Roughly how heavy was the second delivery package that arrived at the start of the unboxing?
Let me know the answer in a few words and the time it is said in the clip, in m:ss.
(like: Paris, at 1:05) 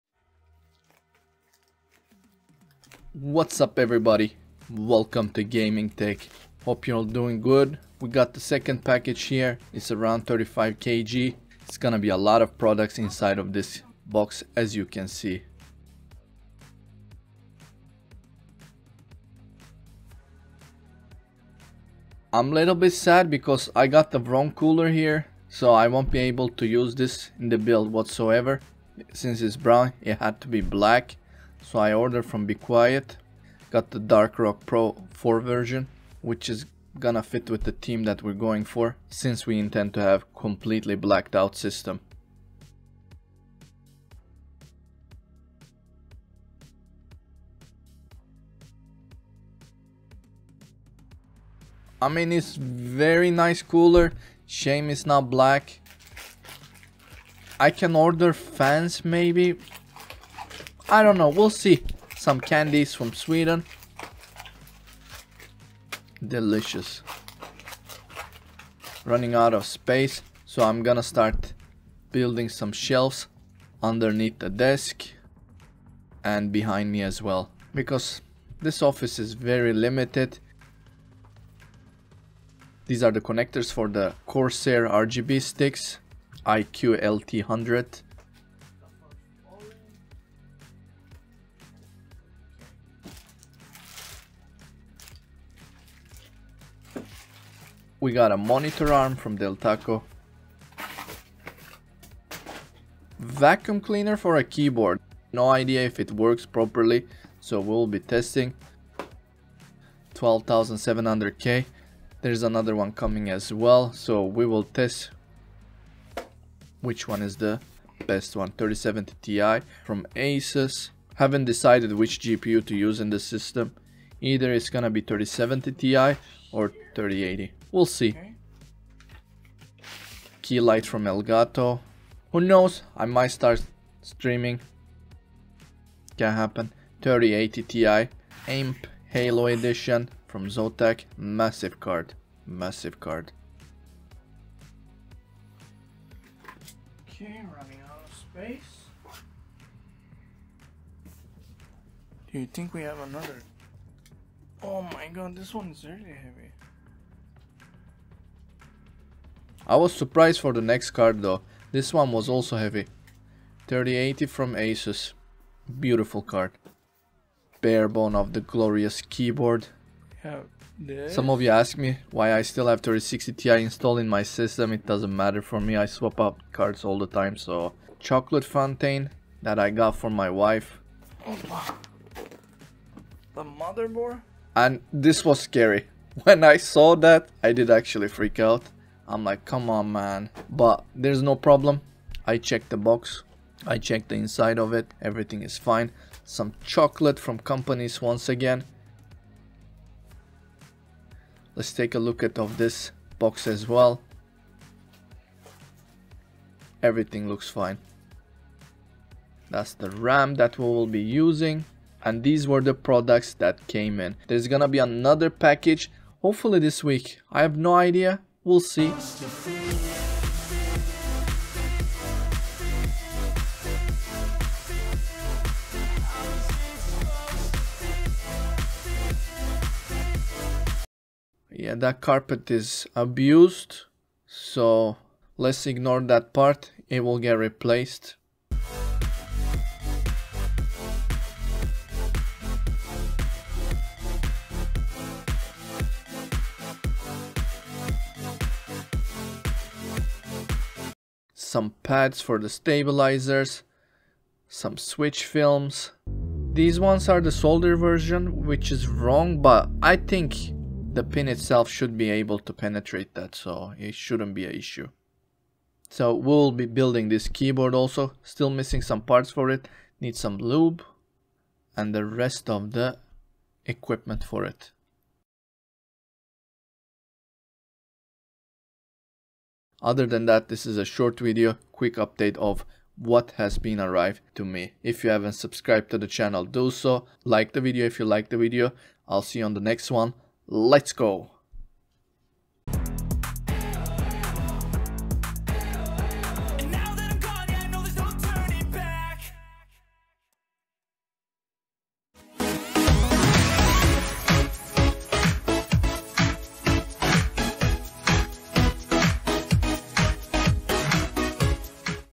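35 kg, at 0:10.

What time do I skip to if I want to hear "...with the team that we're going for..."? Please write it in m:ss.
0:37.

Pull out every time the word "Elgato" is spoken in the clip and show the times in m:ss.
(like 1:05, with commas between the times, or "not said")
2:11.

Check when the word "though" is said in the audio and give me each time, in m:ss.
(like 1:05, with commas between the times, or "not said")
2:41.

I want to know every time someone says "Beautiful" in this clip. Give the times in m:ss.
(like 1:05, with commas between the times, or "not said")
2:45.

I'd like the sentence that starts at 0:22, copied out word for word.
I'm a little bit sad because I got the wrong cooler here.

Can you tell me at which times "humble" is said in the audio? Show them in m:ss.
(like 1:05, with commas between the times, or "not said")
not said.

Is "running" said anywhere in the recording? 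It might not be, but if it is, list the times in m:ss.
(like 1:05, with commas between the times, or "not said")
1:09, 2:27.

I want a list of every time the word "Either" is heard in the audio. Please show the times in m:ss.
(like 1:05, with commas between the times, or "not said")
2:04.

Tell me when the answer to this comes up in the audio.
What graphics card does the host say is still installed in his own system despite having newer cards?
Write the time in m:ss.
2:52.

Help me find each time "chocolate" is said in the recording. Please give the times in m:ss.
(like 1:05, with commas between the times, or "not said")
2:57, 3:16.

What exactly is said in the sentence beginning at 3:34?
There's gonna be another package, hopefully this week.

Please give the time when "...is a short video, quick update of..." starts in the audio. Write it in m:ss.
4:40.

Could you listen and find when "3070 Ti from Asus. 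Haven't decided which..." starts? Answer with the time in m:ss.
1:58.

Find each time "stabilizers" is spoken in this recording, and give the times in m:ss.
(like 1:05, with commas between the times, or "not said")
4:12.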